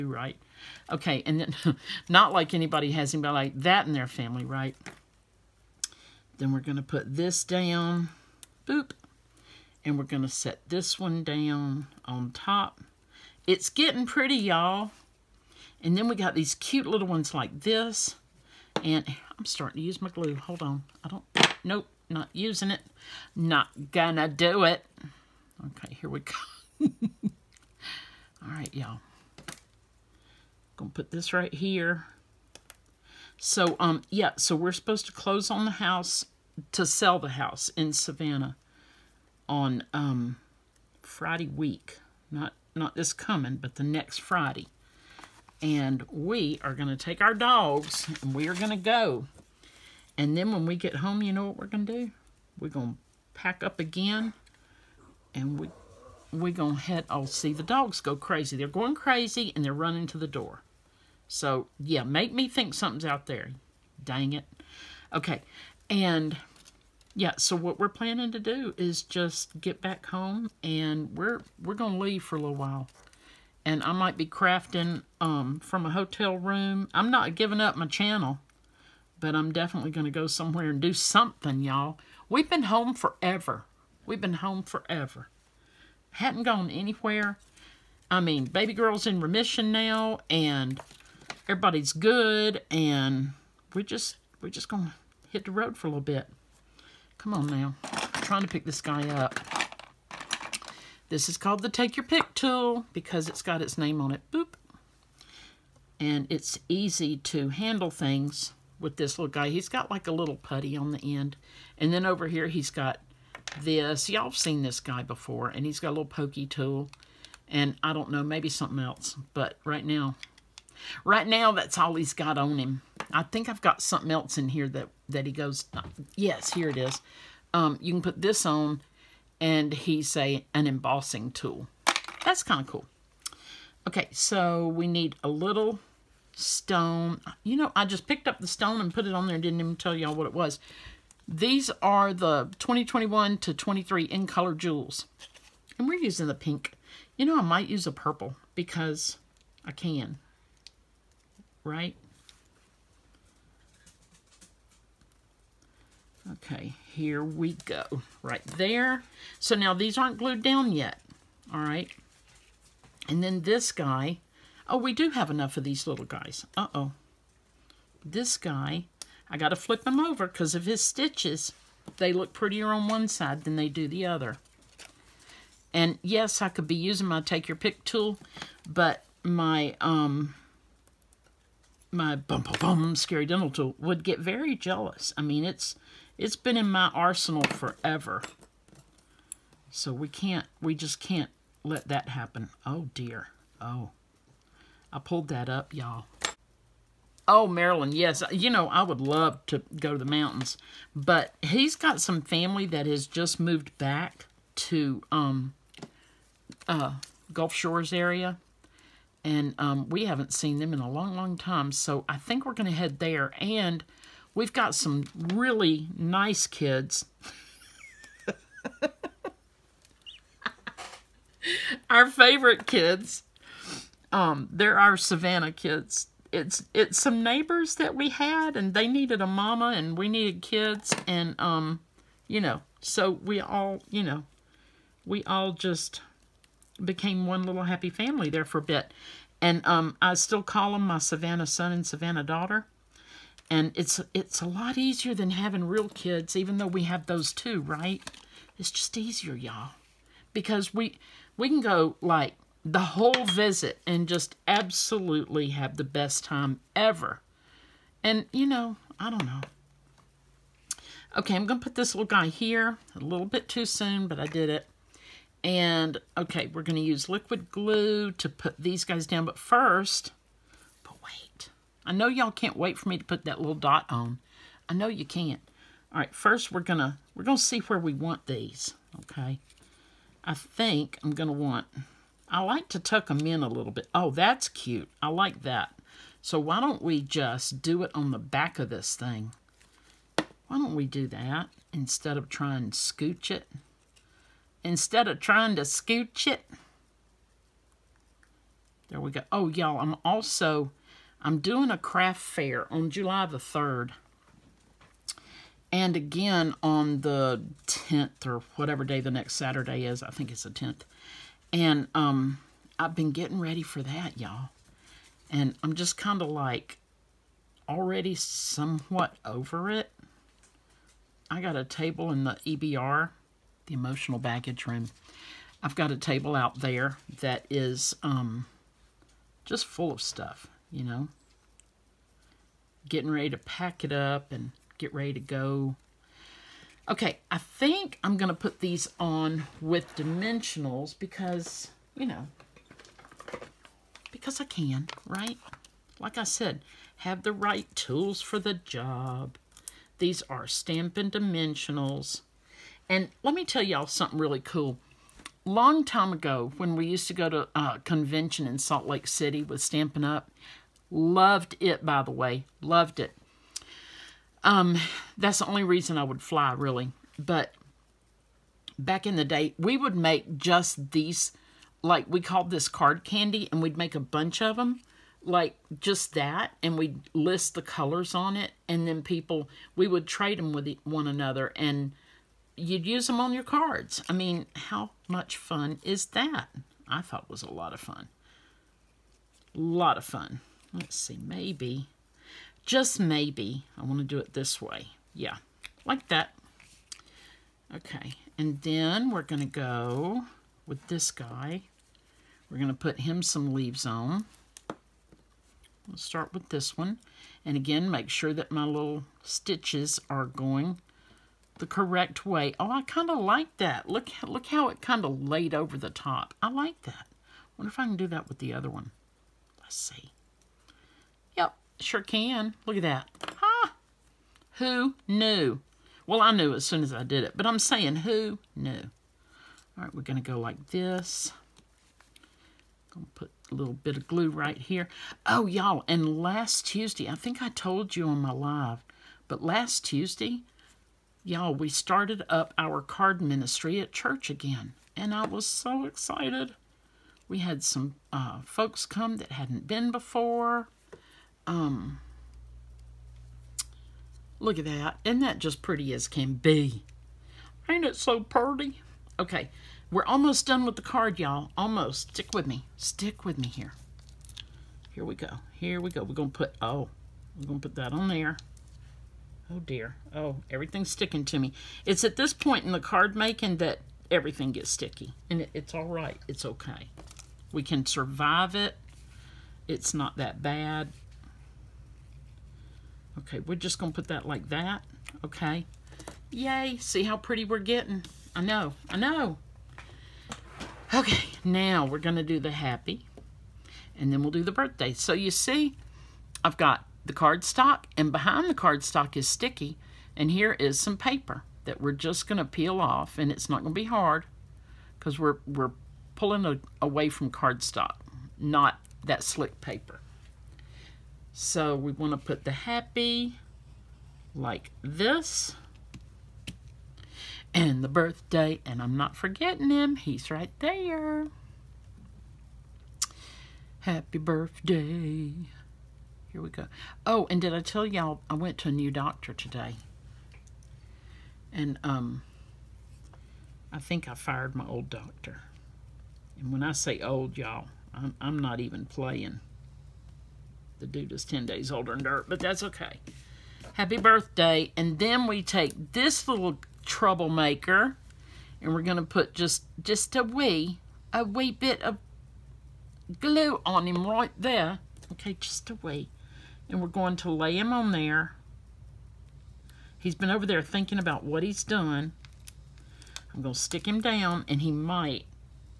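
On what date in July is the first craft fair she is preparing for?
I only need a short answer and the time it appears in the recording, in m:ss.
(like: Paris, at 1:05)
July 3, at 5:02.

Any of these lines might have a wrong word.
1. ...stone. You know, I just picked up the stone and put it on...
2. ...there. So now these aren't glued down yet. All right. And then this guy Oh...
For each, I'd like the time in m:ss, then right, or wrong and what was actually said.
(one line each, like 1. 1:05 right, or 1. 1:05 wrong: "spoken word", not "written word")
1. 2:16 right
2. 2:38 right.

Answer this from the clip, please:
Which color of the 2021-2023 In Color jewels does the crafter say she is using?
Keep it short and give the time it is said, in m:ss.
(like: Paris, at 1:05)
Pink, at 2:26.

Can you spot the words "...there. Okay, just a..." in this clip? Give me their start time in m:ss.
9:14.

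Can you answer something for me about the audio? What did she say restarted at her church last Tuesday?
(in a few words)
Card ministry.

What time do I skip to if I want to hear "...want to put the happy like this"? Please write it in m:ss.
8:31.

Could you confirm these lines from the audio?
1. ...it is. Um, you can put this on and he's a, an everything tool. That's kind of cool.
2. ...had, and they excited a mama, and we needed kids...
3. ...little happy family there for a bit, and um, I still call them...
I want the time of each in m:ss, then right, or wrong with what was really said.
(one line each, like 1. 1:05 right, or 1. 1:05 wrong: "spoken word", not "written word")
1. 2:06 wrong: "embossing", not "everything"
2. 3:48 wrong: "needed", not "excited"
3. 3:57 right.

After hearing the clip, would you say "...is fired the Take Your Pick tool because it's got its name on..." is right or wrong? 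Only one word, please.
wrong.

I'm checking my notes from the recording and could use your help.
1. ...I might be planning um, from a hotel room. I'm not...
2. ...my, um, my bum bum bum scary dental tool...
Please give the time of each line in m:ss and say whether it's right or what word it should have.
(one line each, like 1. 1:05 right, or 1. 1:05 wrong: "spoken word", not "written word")
1. 1:13 wrong: "crafting", not "planning"
2. 2:59 right.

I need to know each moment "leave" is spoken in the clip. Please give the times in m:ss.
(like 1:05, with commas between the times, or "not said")
1:11, 6:43.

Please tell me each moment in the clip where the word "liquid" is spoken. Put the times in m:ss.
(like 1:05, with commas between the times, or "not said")
4:27.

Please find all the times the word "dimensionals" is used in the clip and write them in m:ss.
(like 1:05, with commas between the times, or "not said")
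5:39, 5:51.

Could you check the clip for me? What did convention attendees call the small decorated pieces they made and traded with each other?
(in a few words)
Card candy.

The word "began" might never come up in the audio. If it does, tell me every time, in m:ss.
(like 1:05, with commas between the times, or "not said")
not said.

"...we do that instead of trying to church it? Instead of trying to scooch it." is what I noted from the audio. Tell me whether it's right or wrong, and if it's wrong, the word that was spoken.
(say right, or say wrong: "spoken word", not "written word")
wrong: "scooch", not "church".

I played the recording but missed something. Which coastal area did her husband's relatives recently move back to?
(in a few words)
Gulf Shores.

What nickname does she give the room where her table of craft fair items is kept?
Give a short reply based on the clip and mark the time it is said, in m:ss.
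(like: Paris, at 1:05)
Emotional baggage room, at 5:23.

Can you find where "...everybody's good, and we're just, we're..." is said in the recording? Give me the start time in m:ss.
1:31.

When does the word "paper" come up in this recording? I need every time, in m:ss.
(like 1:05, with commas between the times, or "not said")
8:20, 8:29.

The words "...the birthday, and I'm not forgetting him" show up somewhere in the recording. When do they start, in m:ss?
8:37.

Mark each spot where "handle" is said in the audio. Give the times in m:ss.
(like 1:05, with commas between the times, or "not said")
1:47.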